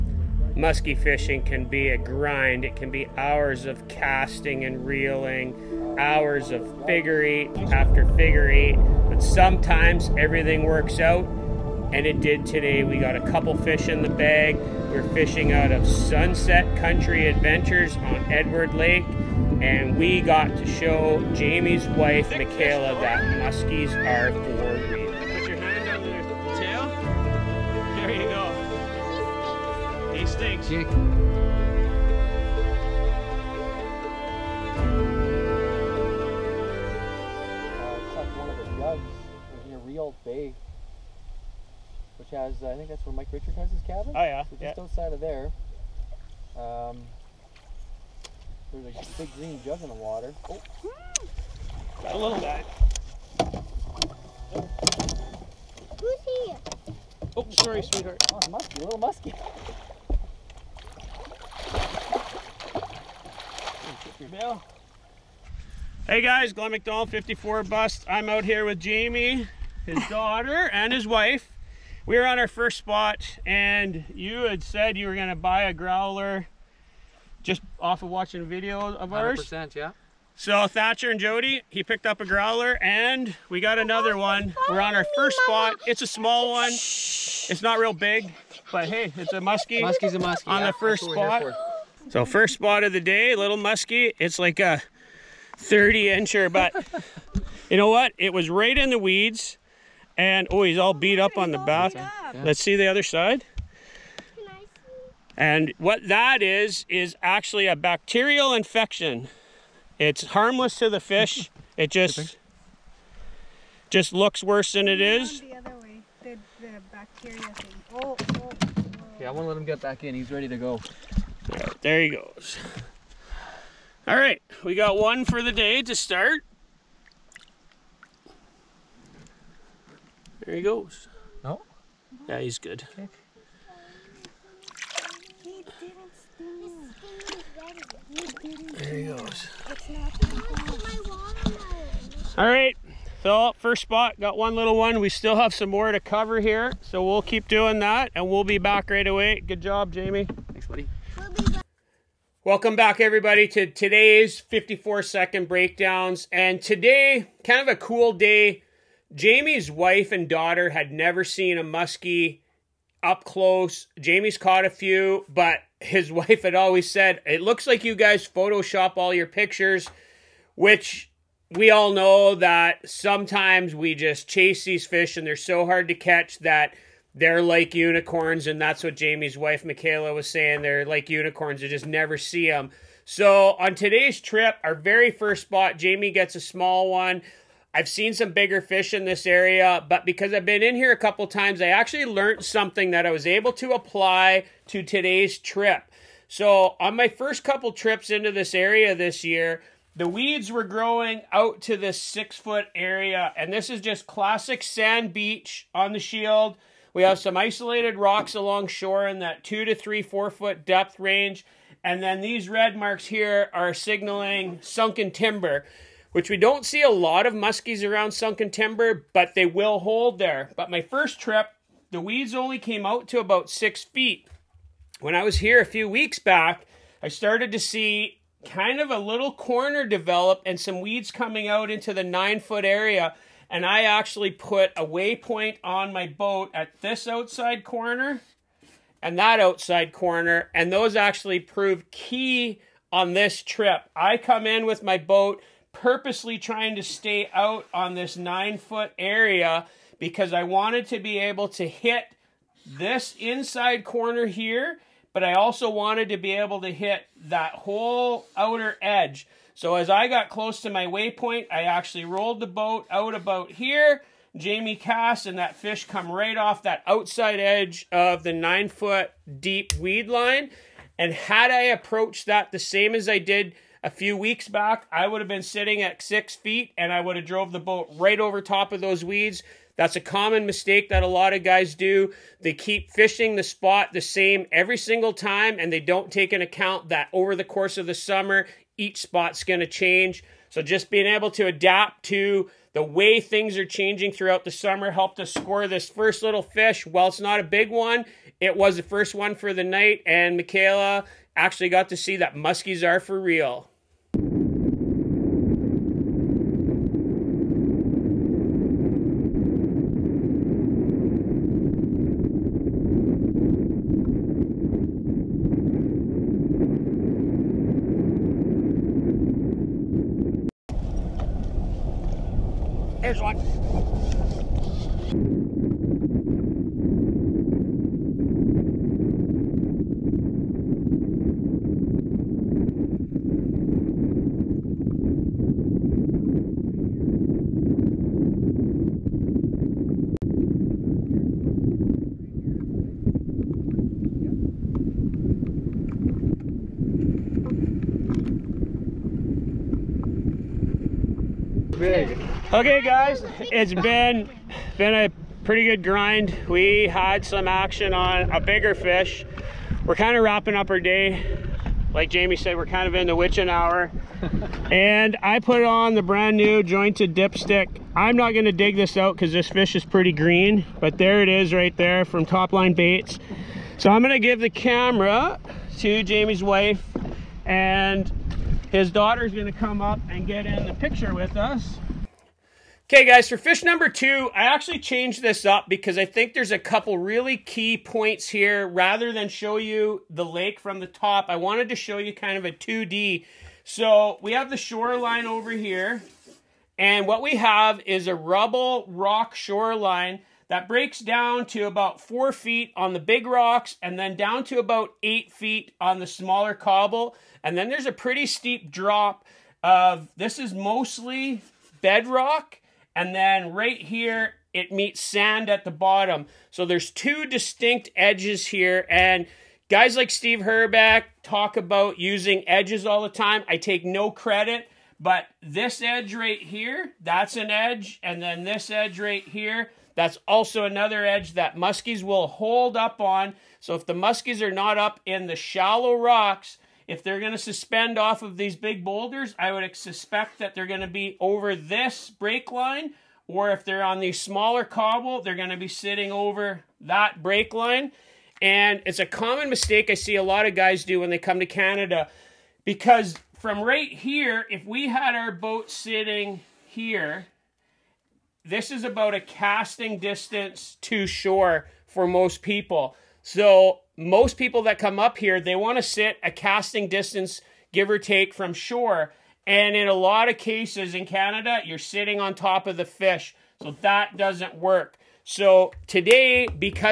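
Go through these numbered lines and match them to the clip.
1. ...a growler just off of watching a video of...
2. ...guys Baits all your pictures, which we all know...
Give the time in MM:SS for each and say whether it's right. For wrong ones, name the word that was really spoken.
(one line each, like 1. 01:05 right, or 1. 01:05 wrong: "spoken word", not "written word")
1. 01:15 right
2. 02:47 wrong: "Photoshop", not "Baits".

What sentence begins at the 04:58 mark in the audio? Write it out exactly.
It was the first one for the night, and Michaela actually got to see that muskies are for real.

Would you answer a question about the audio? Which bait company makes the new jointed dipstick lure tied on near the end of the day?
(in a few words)
Topline Baits.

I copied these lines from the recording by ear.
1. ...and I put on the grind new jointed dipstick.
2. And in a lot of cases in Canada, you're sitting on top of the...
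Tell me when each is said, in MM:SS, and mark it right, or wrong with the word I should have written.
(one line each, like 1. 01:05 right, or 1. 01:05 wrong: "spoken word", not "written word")
1. 06:04 wrong: "brand", not "grind"
2. 07:49 right.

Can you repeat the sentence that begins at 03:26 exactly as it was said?
We have some isolated rocks along shore in that two to three, four foot depth range.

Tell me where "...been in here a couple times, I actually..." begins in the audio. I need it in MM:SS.
03:10.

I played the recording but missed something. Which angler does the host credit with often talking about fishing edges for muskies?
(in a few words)
Steve Herbeck.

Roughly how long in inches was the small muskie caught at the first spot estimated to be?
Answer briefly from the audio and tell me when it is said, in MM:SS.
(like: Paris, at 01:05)
30, at 01:35.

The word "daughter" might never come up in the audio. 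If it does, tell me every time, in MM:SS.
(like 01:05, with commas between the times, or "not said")
01:10, 02:40, 06:18.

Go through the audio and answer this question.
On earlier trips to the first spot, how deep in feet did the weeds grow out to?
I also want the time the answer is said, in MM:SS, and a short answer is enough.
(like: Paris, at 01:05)
6 feet, at 03:21.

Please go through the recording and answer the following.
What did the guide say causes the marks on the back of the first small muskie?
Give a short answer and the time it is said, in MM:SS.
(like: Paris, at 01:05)
bacterial infection, at 01:47.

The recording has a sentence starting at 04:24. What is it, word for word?
Jamie cast and that fish come right off that outside edge of the nine foot deep weed line.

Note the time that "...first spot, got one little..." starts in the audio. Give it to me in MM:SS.
02:23.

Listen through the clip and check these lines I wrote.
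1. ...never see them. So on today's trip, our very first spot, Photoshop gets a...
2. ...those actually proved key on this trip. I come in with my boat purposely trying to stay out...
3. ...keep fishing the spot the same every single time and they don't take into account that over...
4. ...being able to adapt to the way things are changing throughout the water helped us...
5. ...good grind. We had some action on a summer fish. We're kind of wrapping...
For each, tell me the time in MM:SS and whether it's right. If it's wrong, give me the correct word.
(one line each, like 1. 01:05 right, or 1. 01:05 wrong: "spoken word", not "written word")
1. 03:01 wrong: "Jamie", not "Photoshop"
2. 04:00 right
3. 04:42 right
4. 04:50 wrong: "summer", not "water"
5. 05:55 wrong: "bigger", not "summer".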